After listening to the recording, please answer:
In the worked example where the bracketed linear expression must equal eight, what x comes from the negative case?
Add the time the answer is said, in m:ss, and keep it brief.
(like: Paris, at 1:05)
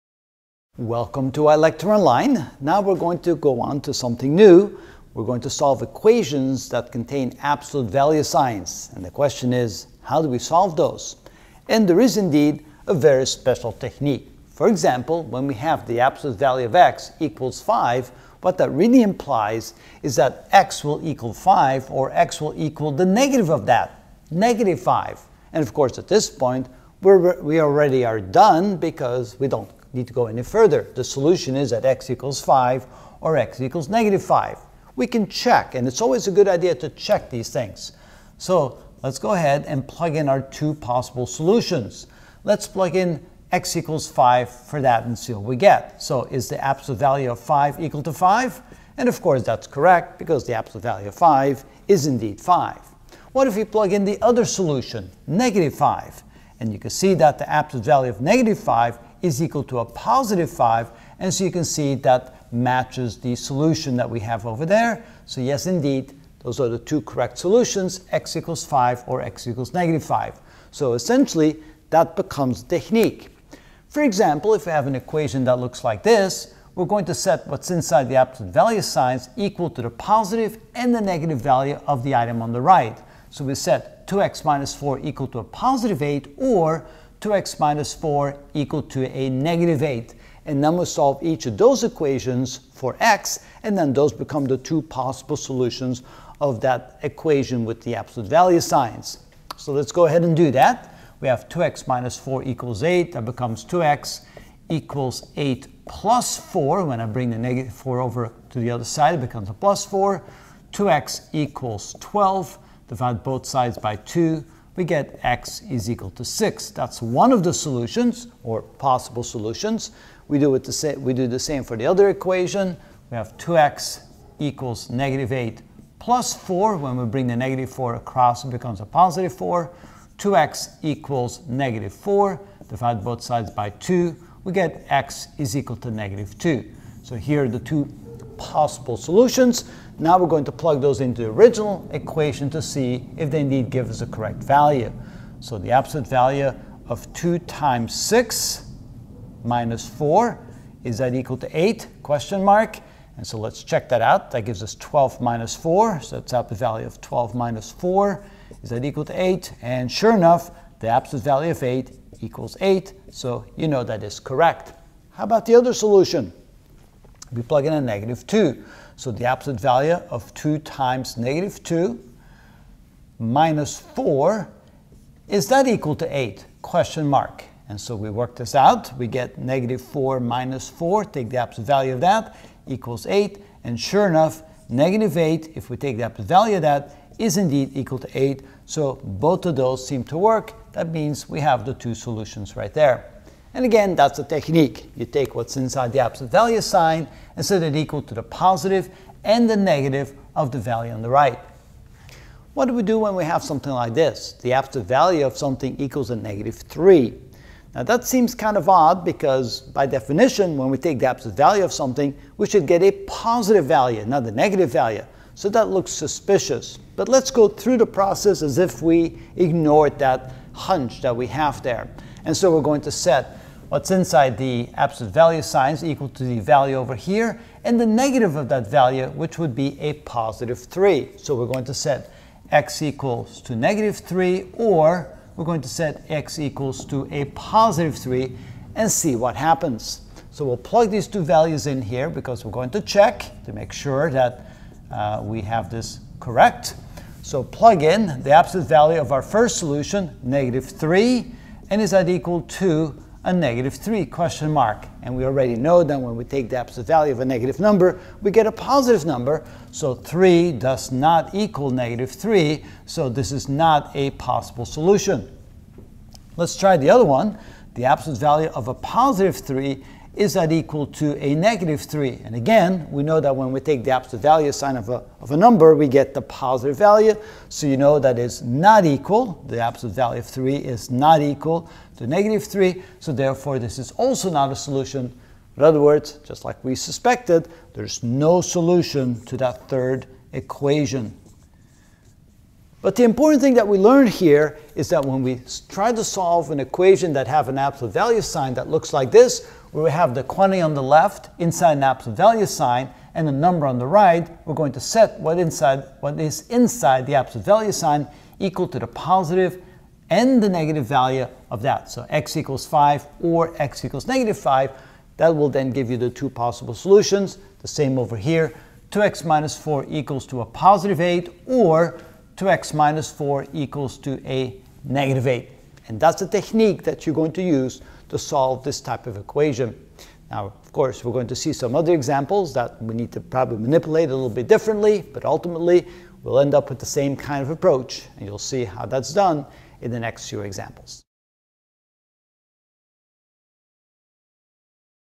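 -2, at 2:14.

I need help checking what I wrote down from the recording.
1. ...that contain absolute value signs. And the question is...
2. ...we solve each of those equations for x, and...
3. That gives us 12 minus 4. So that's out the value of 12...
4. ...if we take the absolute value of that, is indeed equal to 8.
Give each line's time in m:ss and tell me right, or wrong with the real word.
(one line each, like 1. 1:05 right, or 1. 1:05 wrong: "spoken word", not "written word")
1. 0:06 right
2. 1:30 right
3. 2:34 right
4. 3:05 right.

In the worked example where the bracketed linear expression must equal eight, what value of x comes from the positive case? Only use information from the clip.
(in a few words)
6.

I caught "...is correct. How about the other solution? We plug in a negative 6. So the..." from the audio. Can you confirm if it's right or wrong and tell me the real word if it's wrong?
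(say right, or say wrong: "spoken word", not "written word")
wrong: "2", not "6".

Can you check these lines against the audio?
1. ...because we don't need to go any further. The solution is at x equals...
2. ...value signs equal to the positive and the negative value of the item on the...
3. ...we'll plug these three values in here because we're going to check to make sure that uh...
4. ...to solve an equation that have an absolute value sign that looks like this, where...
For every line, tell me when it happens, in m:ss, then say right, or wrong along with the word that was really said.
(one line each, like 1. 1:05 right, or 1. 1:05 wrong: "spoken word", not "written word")
1. 0:28 right
2. 1:18 right
3. 4:00 wrong: "two", not "three"
4. 4:55 right.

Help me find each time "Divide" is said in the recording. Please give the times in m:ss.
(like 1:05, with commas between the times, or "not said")
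1:52, 2:12.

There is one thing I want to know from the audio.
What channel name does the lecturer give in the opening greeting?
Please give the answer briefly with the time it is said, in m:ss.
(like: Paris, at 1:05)
ilectureonline, at 0:01.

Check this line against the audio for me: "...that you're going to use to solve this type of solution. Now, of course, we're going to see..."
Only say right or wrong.
wrong.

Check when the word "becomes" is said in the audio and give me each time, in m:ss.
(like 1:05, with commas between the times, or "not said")
1:12, 1:34, 1:43, 1:49, 2:08.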